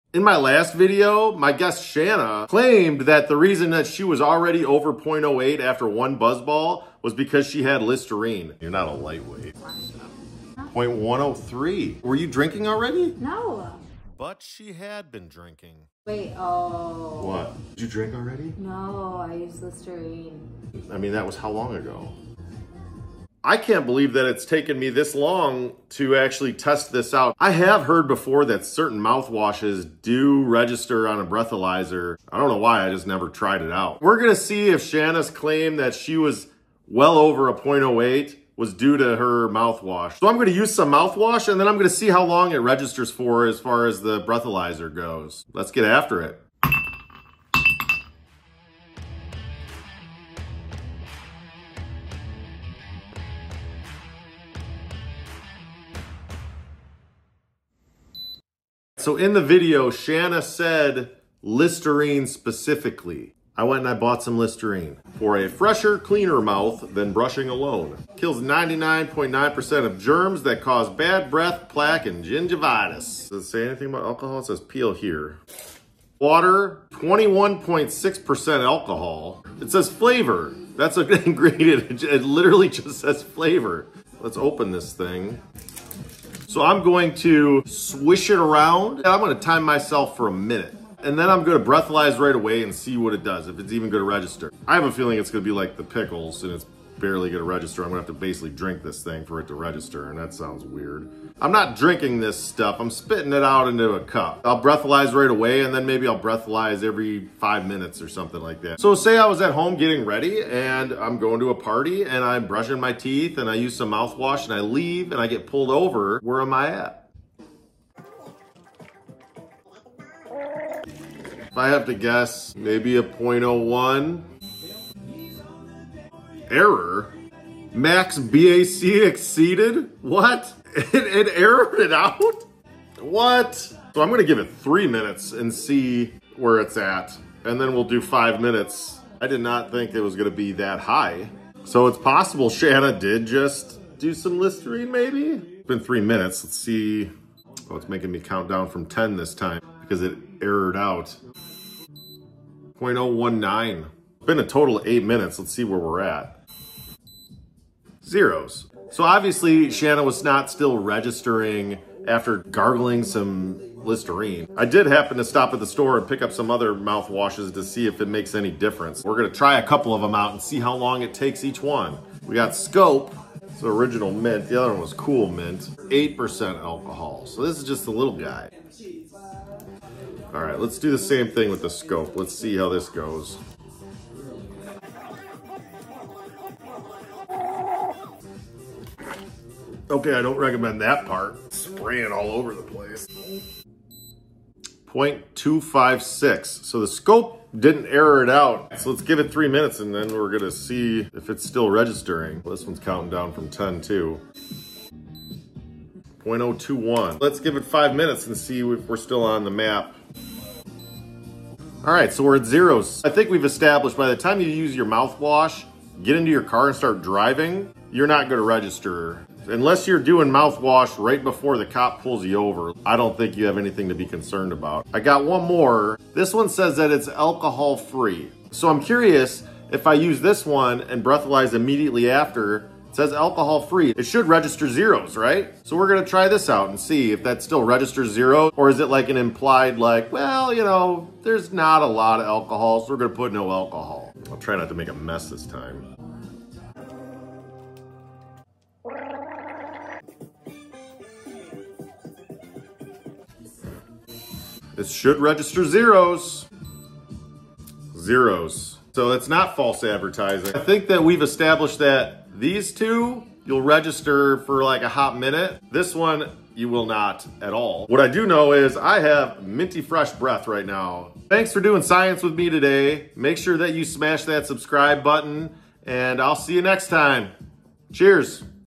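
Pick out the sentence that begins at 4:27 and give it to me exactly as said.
What I do know is I have minty fresh breath right now.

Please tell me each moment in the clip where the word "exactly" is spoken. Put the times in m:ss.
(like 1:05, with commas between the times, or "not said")
not said.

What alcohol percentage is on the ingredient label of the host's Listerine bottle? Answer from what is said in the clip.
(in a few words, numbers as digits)
21.6%.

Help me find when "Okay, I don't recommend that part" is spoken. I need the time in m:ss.
3:09.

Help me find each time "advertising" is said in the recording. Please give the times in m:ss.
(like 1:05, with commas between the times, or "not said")
4:19.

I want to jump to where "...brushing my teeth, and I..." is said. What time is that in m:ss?
1:52.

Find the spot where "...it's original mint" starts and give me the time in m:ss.
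2:53.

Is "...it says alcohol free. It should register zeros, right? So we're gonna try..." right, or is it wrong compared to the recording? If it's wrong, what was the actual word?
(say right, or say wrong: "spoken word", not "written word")
right.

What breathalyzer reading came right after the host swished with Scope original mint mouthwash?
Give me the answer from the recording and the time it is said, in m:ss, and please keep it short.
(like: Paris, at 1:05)
0.256, at 3:14.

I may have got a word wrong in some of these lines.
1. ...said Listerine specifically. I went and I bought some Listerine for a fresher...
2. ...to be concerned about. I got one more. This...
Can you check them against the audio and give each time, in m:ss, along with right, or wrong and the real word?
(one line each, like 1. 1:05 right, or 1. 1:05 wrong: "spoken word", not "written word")
1. 1:00 right
2. 3:43 right.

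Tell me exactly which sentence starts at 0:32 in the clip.
I don't know why, I just never tried it out.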